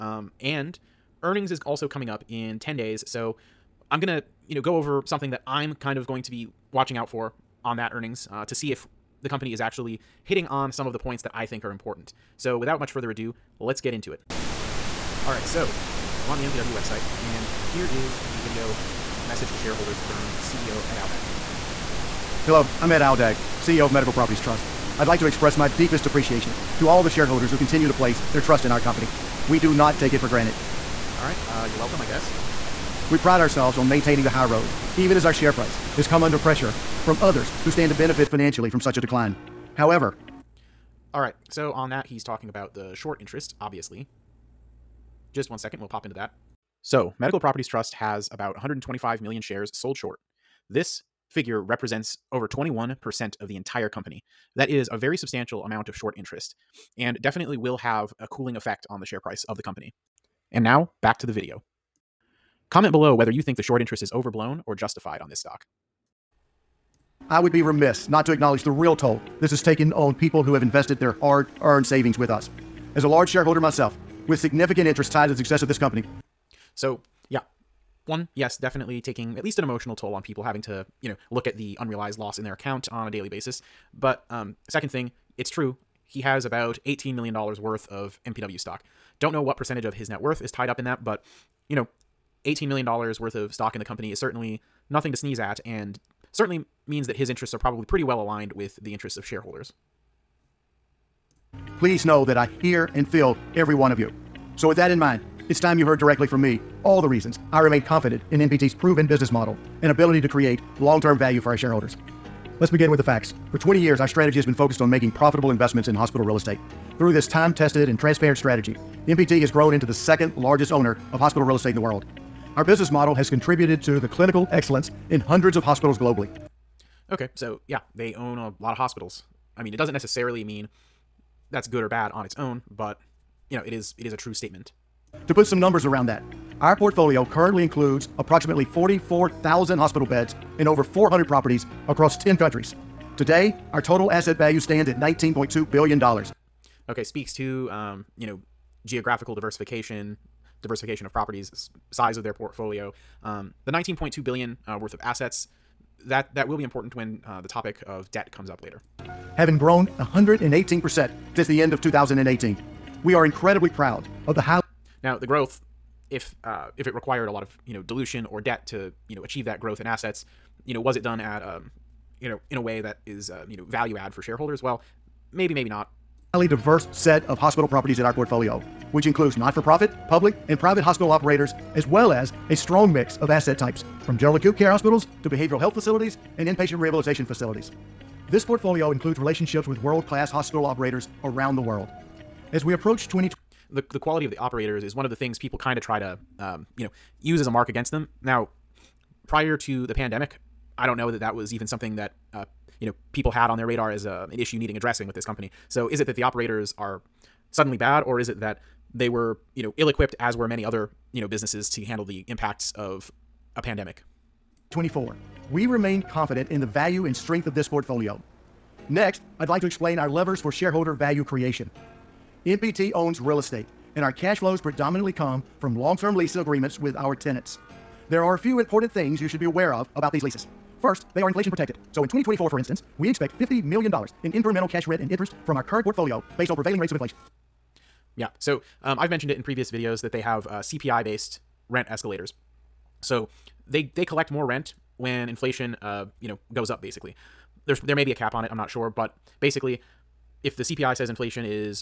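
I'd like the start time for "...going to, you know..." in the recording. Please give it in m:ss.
0:03.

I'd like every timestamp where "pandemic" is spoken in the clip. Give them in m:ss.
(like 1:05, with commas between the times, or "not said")
3:19, 3:33.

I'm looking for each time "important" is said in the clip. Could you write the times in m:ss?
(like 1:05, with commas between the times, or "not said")
0:11, 2:36, 3:48.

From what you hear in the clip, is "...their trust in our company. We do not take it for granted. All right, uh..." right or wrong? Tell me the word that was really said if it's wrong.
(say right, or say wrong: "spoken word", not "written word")
right.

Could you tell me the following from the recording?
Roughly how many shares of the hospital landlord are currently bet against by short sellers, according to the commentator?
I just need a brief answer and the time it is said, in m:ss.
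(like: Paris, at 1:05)
125 million, at 0:48.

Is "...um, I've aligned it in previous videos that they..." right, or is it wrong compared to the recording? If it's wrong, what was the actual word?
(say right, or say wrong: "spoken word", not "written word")
wrong: "mentioned", not "aligned".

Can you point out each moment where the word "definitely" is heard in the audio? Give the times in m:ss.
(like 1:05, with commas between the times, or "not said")
0:57, 1:18.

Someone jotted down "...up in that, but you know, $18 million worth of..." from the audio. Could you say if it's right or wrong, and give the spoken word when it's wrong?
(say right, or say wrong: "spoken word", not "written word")
right.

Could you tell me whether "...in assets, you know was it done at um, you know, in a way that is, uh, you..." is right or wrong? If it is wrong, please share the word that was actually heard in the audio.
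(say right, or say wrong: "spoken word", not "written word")
right.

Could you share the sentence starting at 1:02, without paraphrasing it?
Comment below whether you think the short interest is overblown or justified on this stock.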